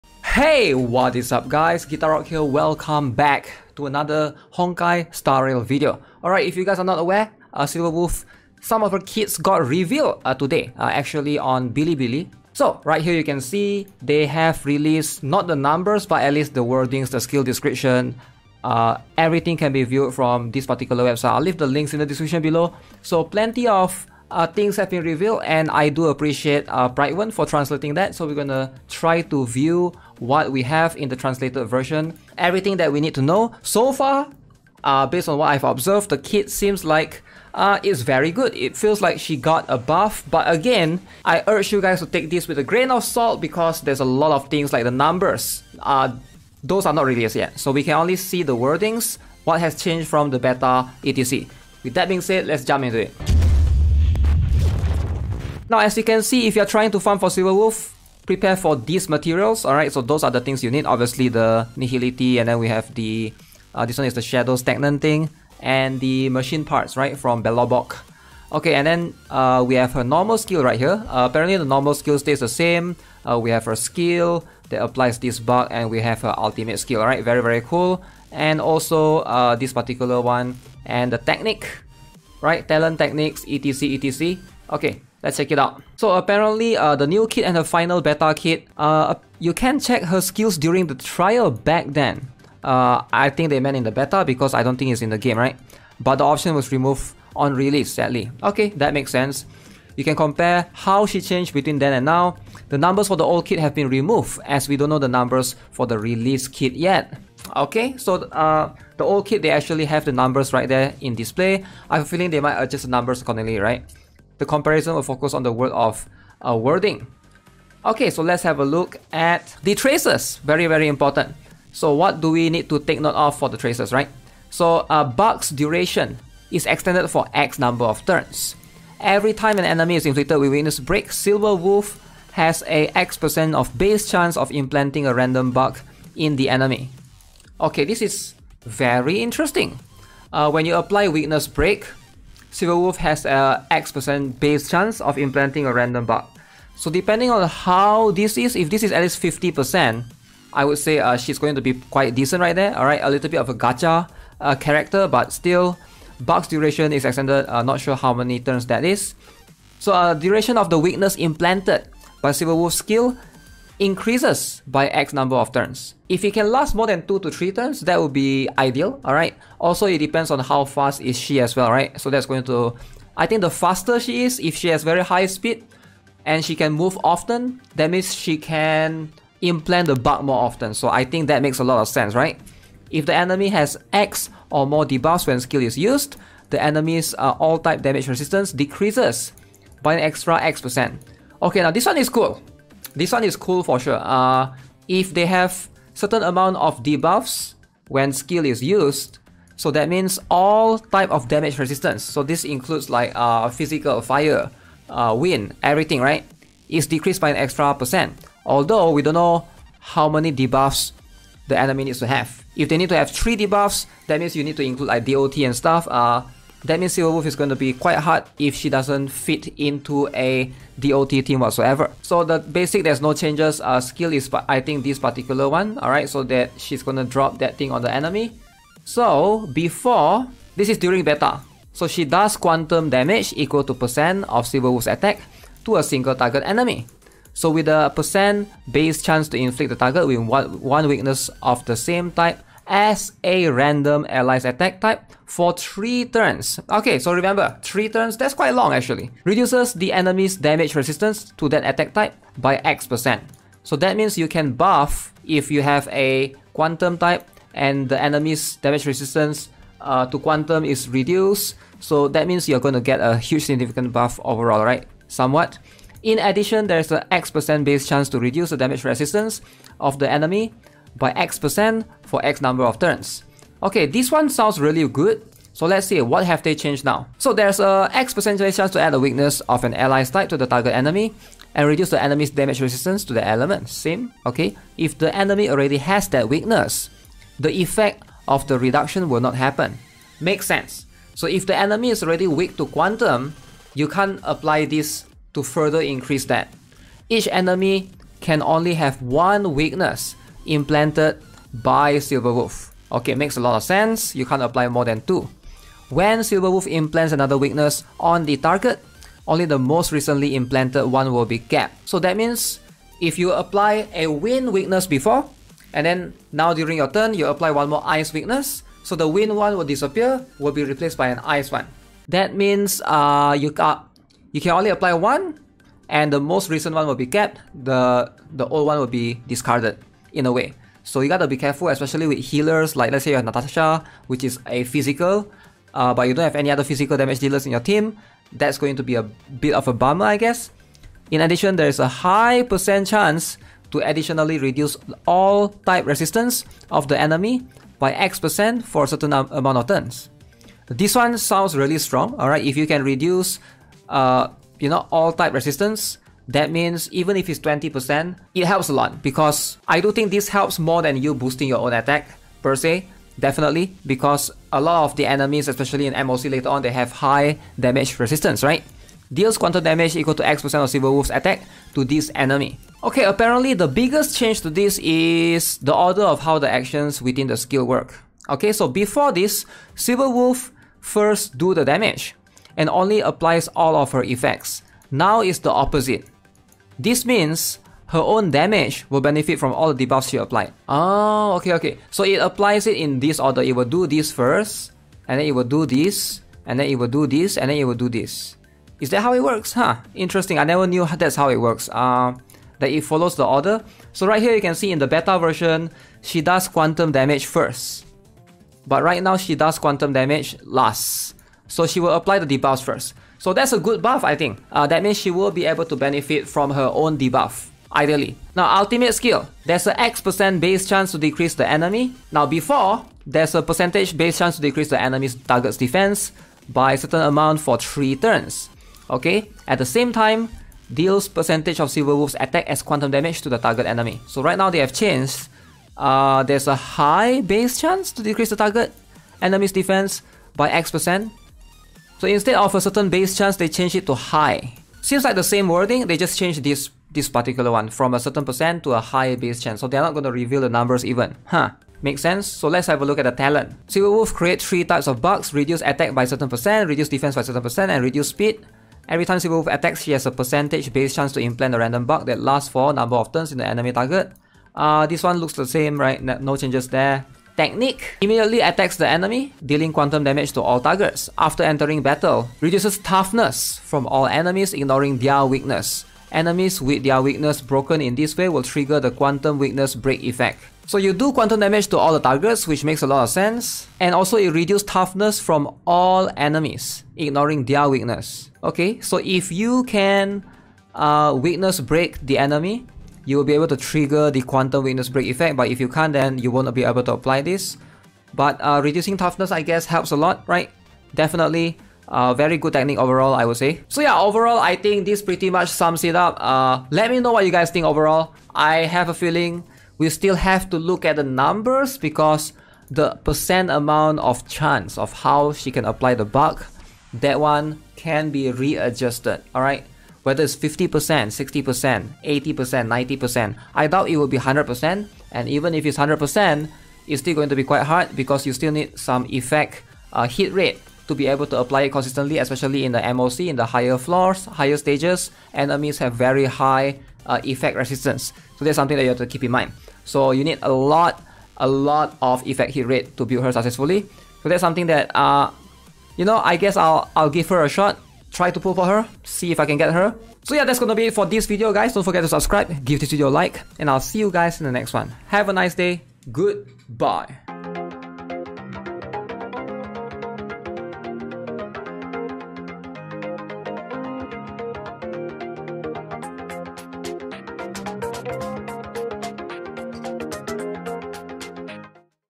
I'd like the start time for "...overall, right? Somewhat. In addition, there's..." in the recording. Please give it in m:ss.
4:24.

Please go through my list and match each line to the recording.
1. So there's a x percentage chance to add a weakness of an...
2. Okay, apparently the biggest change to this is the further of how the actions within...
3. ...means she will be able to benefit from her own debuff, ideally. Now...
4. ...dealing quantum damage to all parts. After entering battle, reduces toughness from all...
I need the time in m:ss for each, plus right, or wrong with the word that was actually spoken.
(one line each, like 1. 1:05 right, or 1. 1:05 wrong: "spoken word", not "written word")
1. 4:37 right
2. 6:12 wrong: "order", not "further"
3. 6:54 right
4. 7:49 wrong: "targets", not "parts".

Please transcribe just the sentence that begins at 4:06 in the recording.
Okay, so remember, 3 turns, that's quite long actually.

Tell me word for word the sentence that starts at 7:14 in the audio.
So right now they have changed.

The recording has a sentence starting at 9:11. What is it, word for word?
Don't forget to subscribe, give this video a like, and I'll see you guys in the next one.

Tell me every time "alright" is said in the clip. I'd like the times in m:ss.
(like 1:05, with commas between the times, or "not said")
0:06, 2:32, 2:49, 3:45, 5:52, 8:39.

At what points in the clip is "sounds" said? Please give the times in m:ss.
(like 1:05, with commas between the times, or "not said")
4:34, 5:51.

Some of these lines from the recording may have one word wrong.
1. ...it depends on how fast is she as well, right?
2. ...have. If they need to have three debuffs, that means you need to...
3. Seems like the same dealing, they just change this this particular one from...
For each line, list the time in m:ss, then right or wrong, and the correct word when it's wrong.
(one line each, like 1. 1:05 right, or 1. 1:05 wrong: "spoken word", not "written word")
1. 2:49 right
2. 3:32 right
3. 7:24 wrong: "wording", not "dealing".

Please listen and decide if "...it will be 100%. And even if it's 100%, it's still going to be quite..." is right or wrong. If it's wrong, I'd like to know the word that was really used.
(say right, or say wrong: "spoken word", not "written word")
right.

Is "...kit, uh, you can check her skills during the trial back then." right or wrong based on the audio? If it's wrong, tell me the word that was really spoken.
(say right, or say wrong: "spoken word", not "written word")
right.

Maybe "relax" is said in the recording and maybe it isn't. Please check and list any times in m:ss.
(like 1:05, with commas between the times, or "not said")
not said.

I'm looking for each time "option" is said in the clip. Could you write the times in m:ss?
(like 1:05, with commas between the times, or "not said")
1:36.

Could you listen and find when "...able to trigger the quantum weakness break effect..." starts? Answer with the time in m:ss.
8:13.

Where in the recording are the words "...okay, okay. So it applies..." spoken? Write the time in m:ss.
6:31.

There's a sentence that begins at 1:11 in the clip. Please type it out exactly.
Uh, apparently, the normal skill stays the same.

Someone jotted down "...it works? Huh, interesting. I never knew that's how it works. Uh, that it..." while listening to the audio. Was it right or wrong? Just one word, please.
right.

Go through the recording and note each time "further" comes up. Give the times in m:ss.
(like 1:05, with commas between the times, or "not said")
4:55.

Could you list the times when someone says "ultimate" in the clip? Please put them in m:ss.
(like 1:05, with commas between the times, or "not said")
1:16, 6:58.